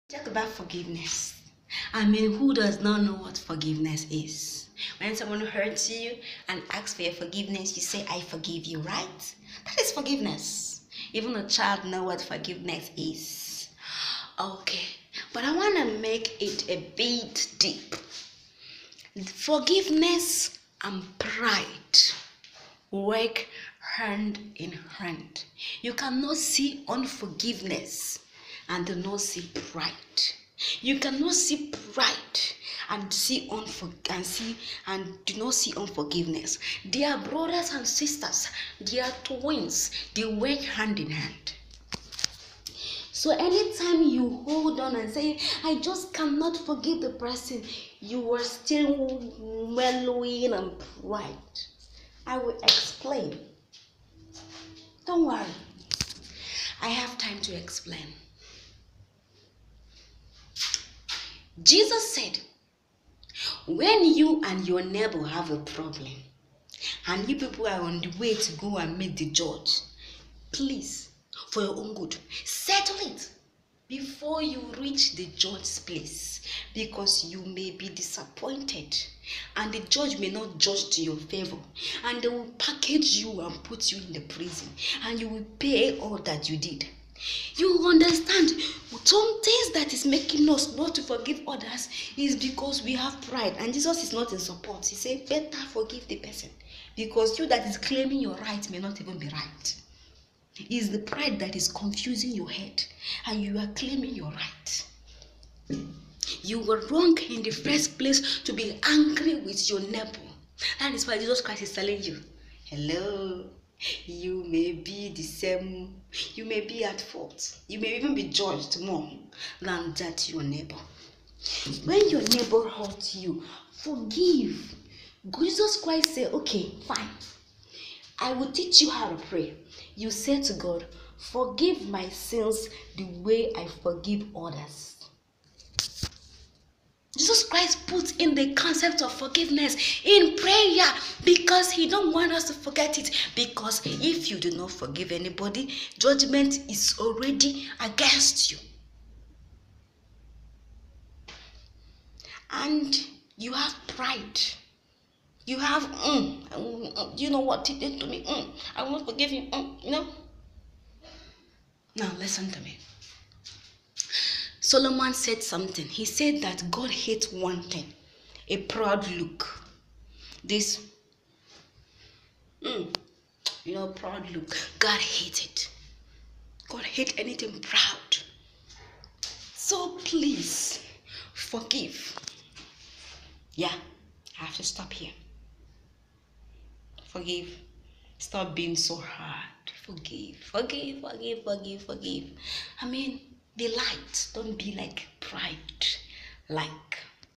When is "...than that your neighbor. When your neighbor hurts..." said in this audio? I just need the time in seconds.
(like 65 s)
119 s.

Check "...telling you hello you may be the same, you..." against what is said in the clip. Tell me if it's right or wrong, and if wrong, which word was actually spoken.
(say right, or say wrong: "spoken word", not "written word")
right.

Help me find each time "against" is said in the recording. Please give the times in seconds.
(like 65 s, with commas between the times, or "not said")
147 s.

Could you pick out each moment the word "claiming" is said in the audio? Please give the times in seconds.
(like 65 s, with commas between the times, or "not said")
97 s, 103 s.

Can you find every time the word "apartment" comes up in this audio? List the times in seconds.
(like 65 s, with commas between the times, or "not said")
not said.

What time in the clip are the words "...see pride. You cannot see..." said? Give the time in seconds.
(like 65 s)
29 s.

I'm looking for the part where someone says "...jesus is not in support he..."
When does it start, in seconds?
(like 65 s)
93 s.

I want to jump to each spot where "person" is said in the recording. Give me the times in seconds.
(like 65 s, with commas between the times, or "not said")
47 s, 96 s.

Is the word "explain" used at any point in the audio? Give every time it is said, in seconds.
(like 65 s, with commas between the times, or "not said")
52 s, 57 s.